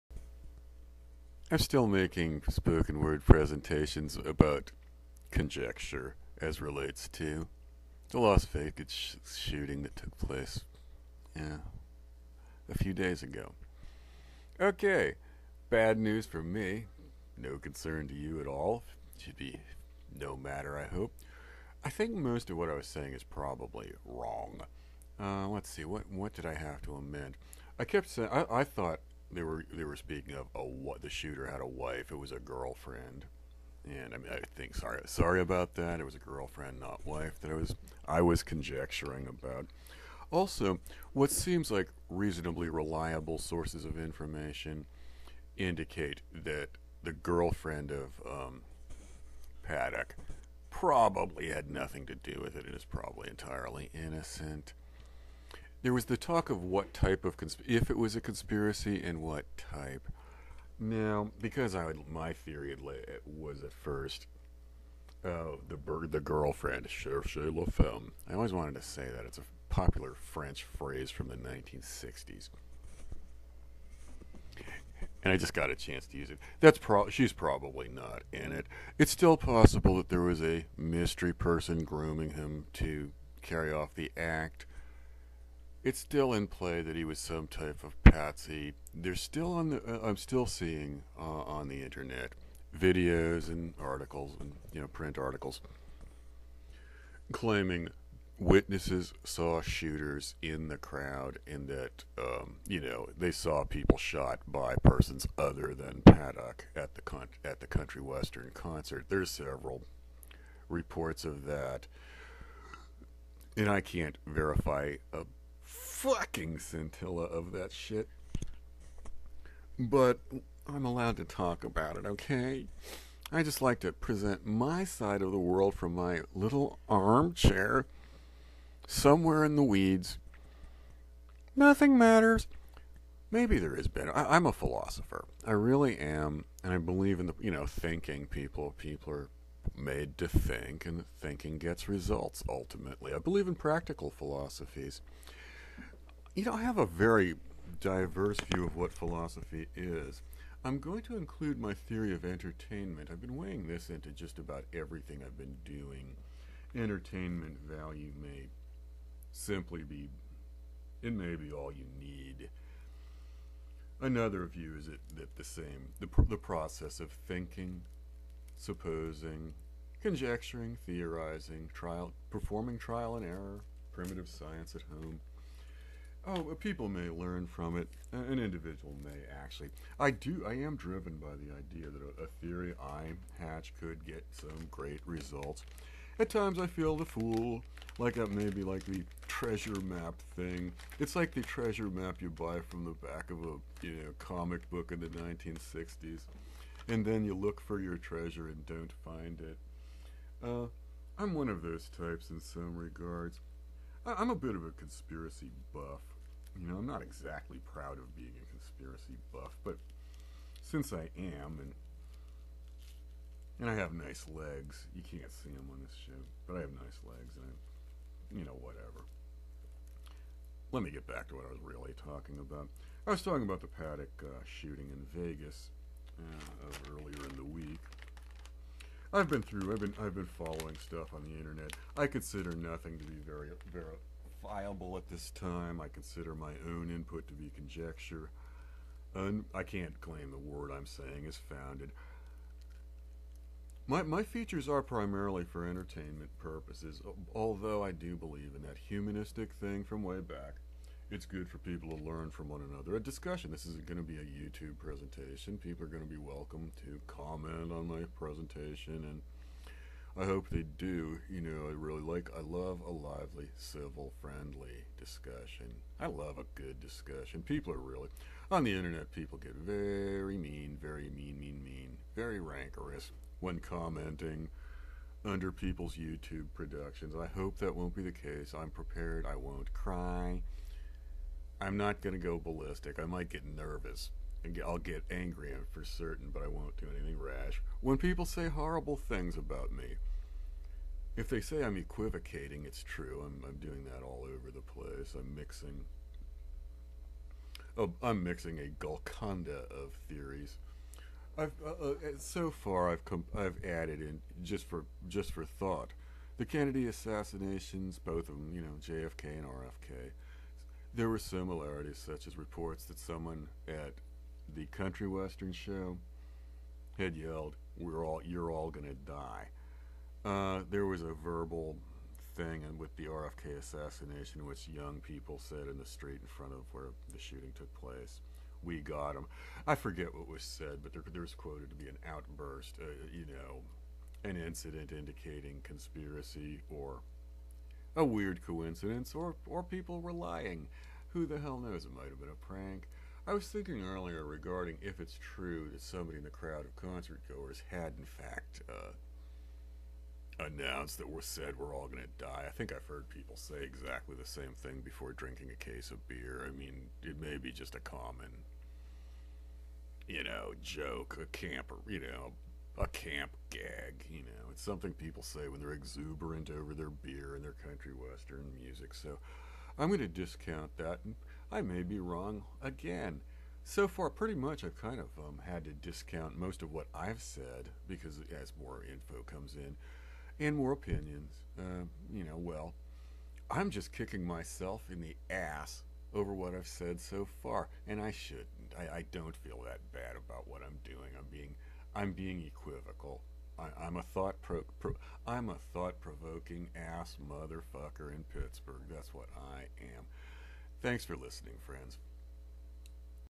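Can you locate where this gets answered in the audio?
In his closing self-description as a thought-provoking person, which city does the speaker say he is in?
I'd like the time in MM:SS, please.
06:38.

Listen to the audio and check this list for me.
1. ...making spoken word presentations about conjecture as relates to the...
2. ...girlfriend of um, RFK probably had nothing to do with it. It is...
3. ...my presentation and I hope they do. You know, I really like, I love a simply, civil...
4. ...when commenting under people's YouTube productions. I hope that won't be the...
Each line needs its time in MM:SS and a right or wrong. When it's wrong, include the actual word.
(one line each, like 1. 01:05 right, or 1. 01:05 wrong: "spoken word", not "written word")
1. 00:01 right
2. 00:47 wrong: "Paddock", not "RFK"
3. 04:17 wrong: "lively", not "simply"
4. 04:33 right.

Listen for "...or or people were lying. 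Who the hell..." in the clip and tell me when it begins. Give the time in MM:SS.
05:39.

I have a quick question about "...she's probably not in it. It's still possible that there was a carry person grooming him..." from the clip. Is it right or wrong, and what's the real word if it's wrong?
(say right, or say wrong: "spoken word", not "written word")
wrong: "mystery", not "carry".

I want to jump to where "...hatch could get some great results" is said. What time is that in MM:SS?
03:03.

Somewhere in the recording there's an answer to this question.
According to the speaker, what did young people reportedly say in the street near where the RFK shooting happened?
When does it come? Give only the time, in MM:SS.
05:28.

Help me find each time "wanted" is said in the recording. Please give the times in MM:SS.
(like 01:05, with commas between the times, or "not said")
01:08.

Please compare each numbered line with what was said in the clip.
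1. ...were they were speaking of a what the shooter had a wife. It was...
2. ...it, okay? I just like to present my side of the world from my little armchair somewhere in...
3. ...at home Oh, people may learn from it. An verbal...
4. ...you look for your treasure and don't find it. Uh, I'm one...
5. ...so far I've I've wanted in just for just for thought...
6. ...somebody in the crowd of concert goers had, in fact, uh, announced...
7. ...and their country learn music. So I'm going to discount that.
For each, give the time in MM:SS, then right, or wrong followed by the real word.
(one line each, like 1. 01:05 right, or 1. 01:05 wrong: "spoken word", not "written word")
1. 00:29 right
2. 02:01 right
3. 02:54 wrong: "individual", not "verbal"
4. 03:17 right
5. 05:02 wrong: "added", not "wanted"
6. 05:45 right
7. 06:07 wrong: "western", not "learn".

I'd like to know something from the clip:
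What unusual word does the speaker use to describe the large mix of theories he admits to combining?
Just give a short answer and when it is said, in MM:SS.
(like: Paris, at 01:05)
Golconda, at 04:58.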